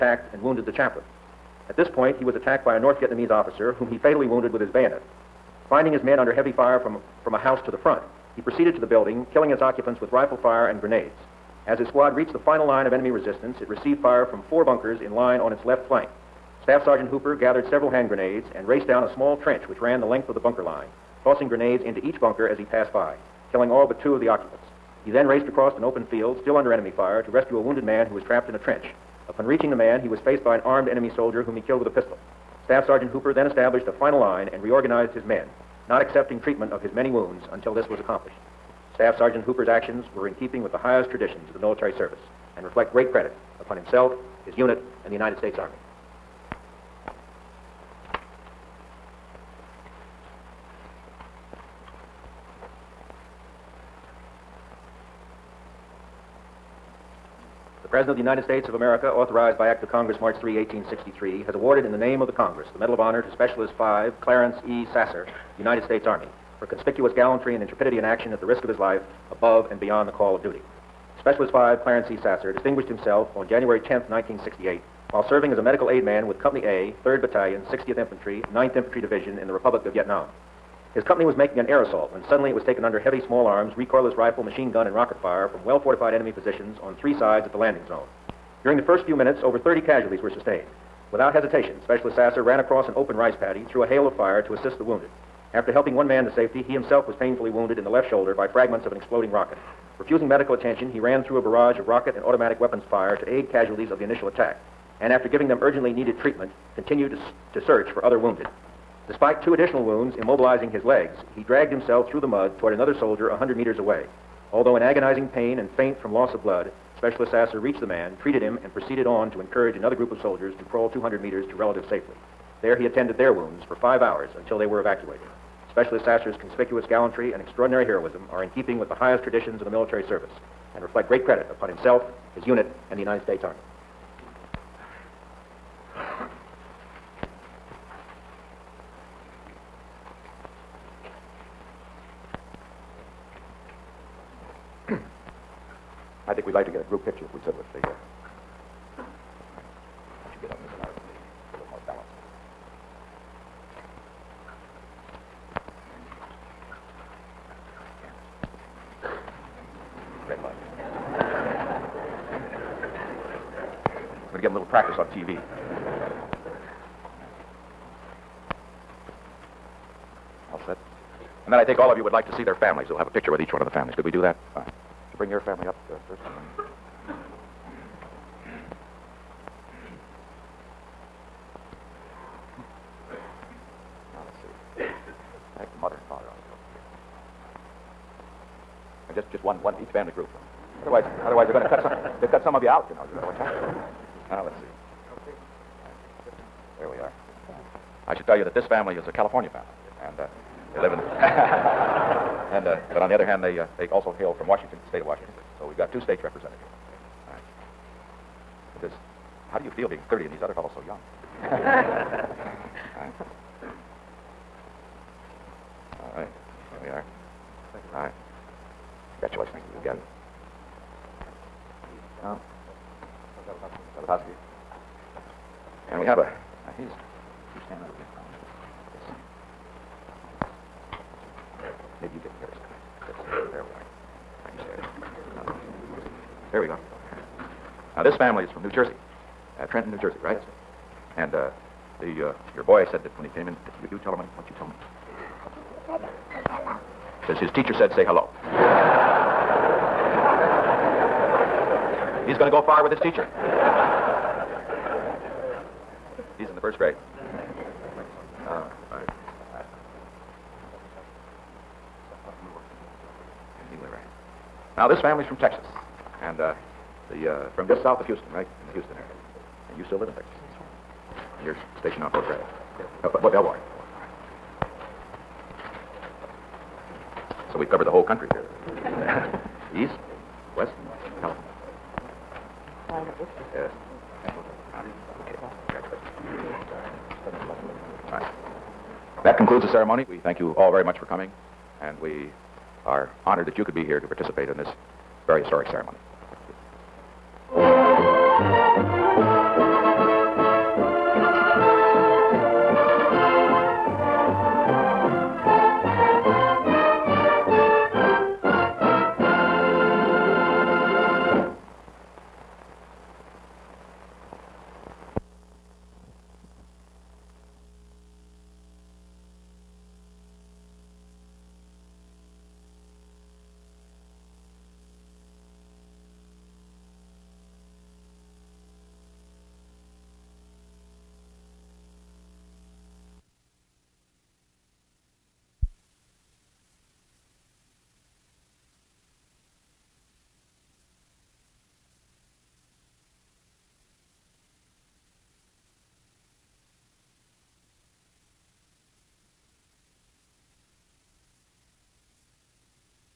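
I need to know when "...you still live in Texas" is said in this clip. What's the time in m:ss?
4:29.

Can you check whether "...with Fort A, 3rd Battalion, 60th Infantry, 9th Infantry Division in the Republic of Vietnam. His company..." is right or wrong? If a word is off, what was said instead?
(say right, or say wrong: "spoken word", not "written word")
wrong: "Company", not "Fort".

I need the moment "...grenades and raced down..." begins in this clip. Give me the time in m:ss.
0:18.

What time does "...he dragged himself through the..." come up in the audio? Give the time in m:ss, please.
1:51.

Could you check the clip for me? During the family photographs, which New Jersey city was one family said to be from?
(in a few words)
Trenton.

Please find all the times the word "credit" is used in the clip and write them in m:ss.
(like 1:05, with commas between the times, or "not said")
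0:43, 2:11.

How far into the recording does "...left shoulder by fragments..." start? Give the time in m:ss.
1:37.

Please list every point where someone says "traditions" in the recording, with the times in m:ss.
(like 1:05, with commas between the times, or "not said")
0:41, 2:09.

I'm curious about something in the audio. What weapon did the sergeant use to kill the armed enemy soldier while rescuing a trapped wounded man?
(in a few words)
Pistol.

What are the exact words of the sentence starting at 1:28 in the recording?
During the first few minutes, over 30 casualties were sustained.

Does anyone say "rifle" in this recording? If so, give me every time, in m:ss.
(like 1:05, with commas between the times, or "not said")
0:10, 1:24.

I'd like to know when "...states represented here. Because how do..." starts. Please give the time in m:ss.
3:26.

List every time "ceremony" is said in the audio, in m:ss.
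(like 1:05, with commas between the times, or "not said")
4:49, 4:55.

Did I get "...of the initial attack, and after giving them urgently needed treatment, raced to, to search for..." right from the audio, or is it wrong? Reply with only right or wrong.
wrong.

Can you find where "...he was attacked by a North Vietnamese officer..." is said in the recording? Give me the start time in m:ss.
0:02.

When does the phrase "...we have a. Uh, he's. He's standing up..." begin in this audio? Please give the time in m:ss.
3:45.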